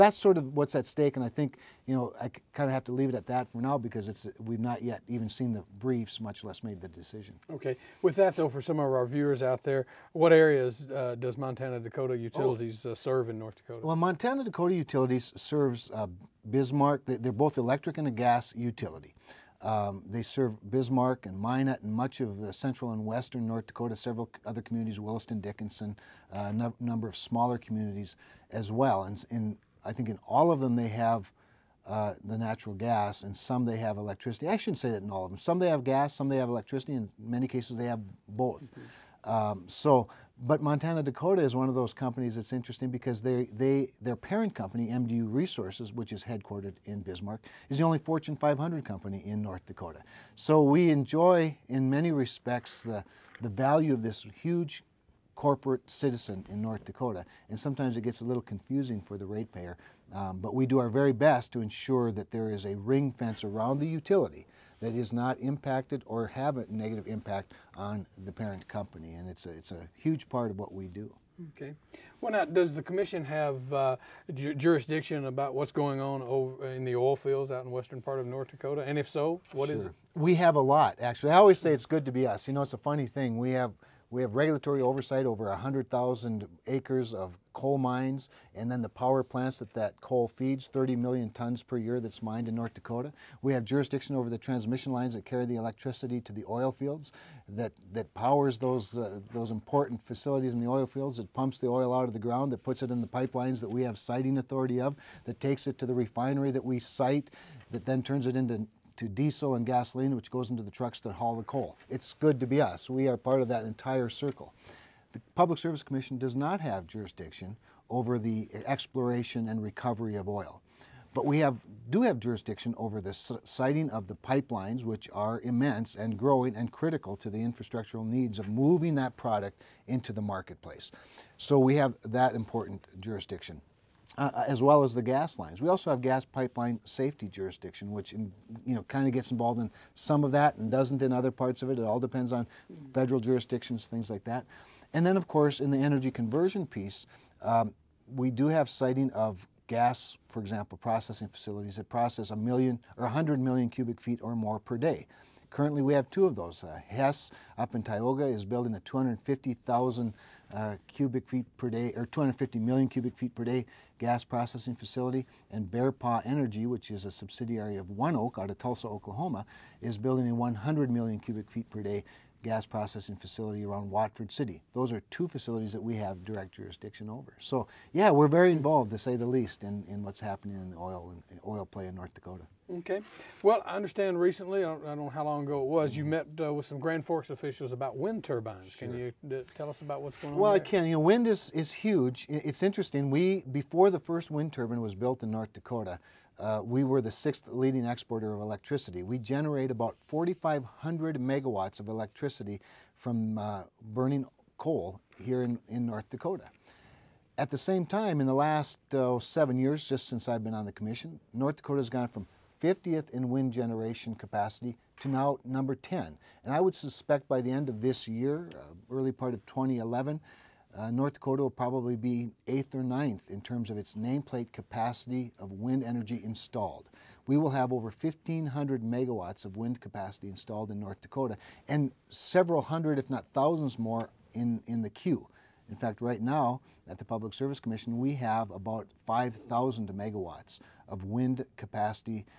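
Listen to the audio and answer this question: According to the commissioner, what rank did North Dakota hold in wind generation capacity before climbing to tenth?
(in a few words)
50th.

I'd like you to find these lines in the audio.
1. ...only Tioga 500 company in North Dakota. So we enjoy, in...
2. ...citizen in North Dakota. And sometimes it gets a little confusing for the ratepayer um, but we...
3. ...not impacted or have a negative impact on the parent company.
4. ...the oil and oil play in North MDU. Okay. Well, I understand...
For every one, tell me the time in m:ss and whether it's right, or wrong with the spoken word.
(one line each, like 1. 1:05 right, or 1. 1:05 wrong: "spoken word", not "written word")
1. 0:47 wrong: "Fortune", not "Tioga"
2. 0:55 right
3. 1:05 right
4. 3:00 wrong: "Dakota", not "MDU".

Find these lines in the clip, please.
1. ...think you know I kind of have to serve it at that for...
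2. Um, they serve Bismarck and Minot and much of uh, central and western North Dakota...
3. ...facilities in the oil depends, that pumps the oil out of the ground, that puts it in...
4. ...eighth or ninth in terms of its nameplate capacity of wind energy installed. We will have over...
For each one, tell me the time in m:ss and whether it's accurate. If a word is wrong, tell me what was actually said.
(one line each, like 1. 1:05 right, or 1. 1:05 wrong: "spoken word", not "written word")
1. 0:01 wrong: "leave", not "serve"
2. 0:19 right
3. 1:40 wrong: "fields", not "depends"
4. 3:42 right.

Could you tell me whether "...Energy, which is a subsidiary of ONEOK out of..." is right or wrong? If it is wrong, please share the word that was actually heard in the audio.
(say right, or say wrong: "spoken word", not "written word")
right.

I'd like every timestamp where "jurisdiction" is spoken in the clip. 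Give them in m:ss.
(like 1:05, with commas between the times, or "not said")
1:14, 1:33, 1:56, 2:02, 2:12, 2:17, 2:23, 2:56.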